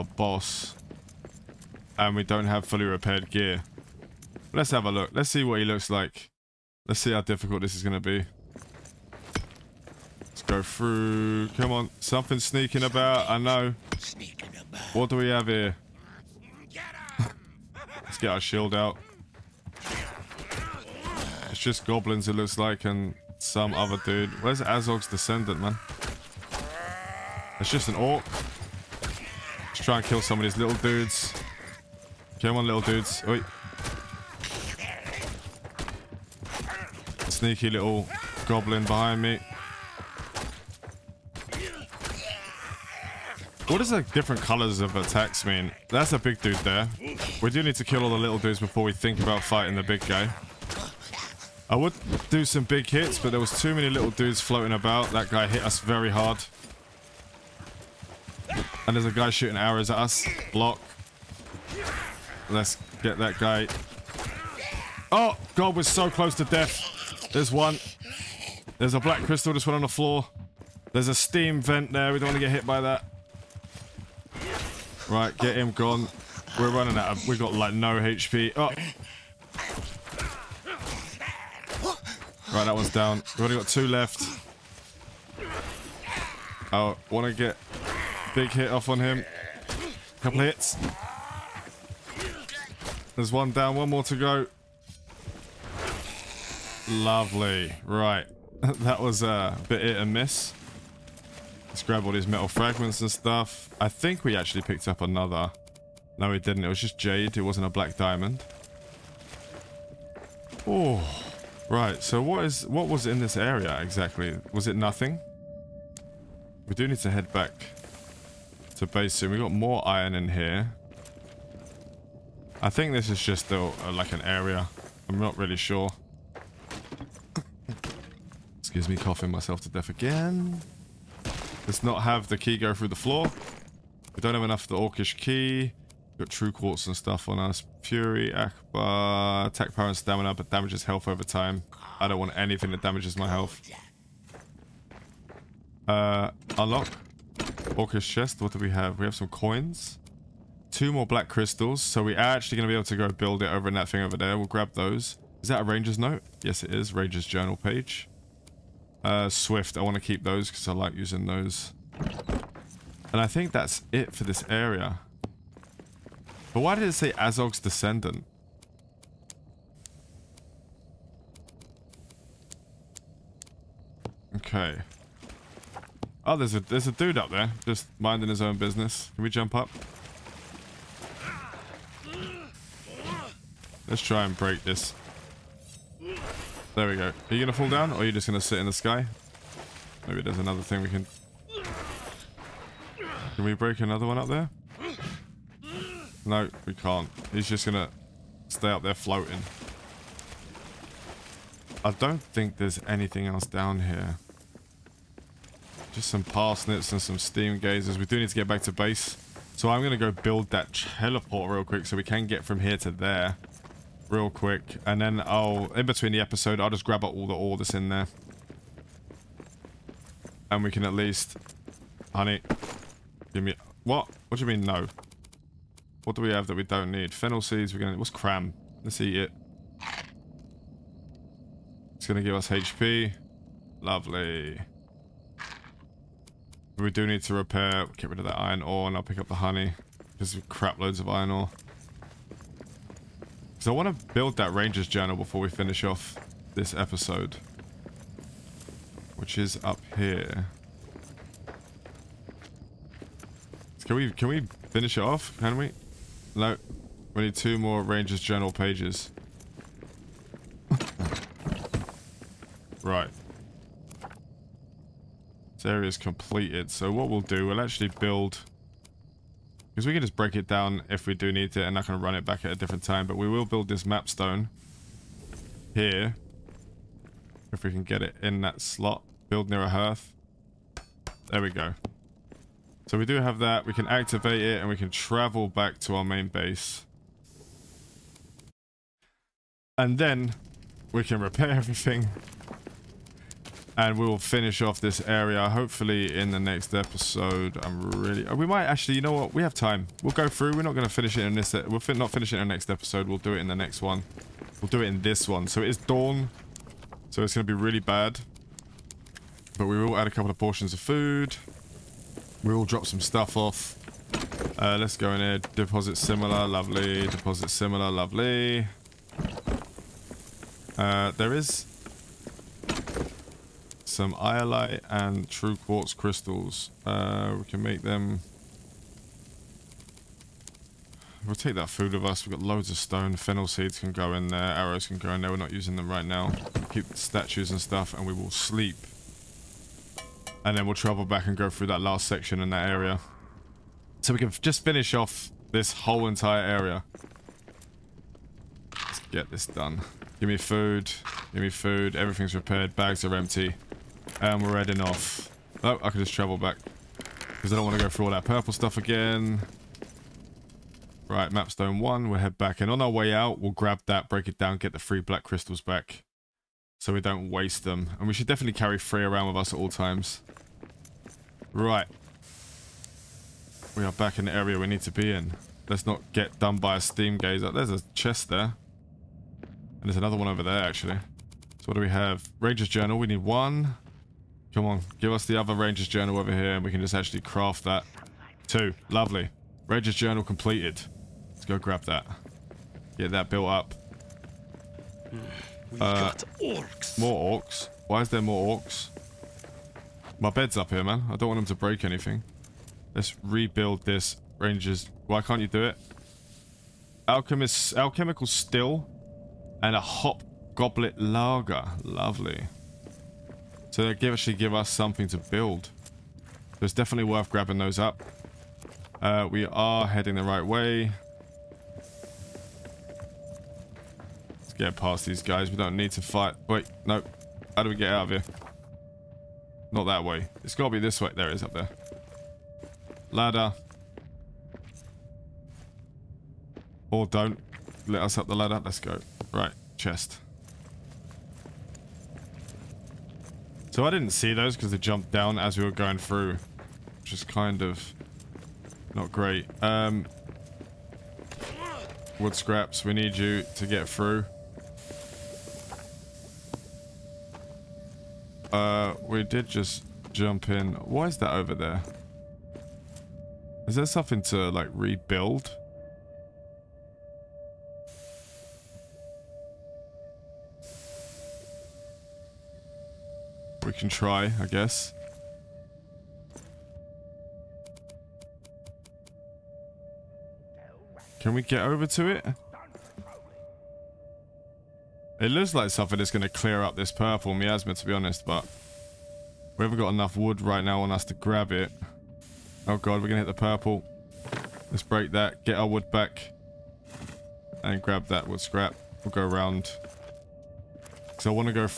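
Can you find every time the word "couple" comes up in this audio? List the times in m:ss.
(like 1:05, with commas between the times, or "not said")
1:30, 5:10.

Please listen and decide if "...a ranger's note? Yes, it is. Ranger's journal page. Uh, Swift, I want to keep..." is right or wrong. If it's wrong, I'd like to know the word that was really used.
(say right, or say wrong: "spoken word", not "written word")
right.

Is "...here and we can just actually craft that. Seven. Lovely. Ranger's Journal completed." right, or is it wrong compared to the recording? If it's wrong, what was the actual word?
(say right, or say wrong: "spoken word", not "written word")
wrong: "Two", not "Seven".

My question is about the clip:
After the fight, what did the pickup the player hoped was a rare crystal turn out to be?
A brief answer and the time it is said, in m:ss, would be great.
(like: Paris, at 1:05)
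Jade, at 1:46.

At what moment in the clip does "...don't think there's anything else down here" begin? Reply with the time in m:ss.
3:21.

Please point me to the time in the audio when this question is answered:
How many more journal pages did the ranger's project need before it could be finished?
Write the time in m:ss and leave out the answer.
4:17.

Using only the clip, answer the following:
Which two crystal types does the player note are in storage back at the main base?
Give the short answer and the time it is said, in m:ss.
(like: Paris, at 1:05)
Iolite and true quartz, at 5:24.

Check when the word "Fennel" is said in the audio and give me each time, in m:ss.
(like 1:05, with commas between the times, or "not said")
3:47, 5:33.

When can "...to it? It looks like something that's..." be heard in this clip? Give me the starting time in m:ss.
8:01.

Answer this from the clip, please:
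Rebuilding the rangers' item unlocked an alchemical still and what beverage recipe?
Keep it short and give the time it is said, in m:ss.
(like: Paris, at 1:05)
Hop goblet lager, at 6:49.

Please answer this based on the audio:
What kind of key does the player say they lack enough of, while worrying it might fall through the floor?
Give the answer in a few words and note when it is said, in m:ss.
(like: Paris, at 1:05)
Orcish key, at 2:14.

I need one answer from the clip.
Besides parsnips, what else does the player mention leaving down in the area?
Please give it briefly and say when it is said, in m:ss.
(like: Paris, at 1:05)
Steam gazers, at 3:27.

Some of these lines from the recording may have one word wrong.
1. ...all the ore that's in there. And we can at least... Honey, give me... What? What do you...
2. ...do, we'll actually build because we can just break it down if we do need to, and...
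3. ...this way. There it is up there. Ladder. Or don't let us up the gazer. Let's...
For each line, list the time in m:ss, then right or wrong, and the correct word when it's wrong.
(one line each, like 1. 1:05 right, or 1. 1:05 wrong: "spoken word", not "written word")
1. 3:37 right
2. 4:27 right
3. 7:10 wrong: "ladder", not "gazer".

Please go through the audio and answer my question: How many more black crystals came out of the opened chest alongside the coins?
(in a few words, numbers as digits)
2.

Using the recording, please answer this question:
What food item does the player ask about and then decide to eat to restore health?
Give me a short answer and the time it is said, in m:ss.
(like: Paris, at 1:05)
Cram, at 3:47.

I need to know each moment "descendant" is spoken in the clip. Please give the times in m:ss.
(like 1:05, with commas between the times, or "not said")
0:25, 2:47.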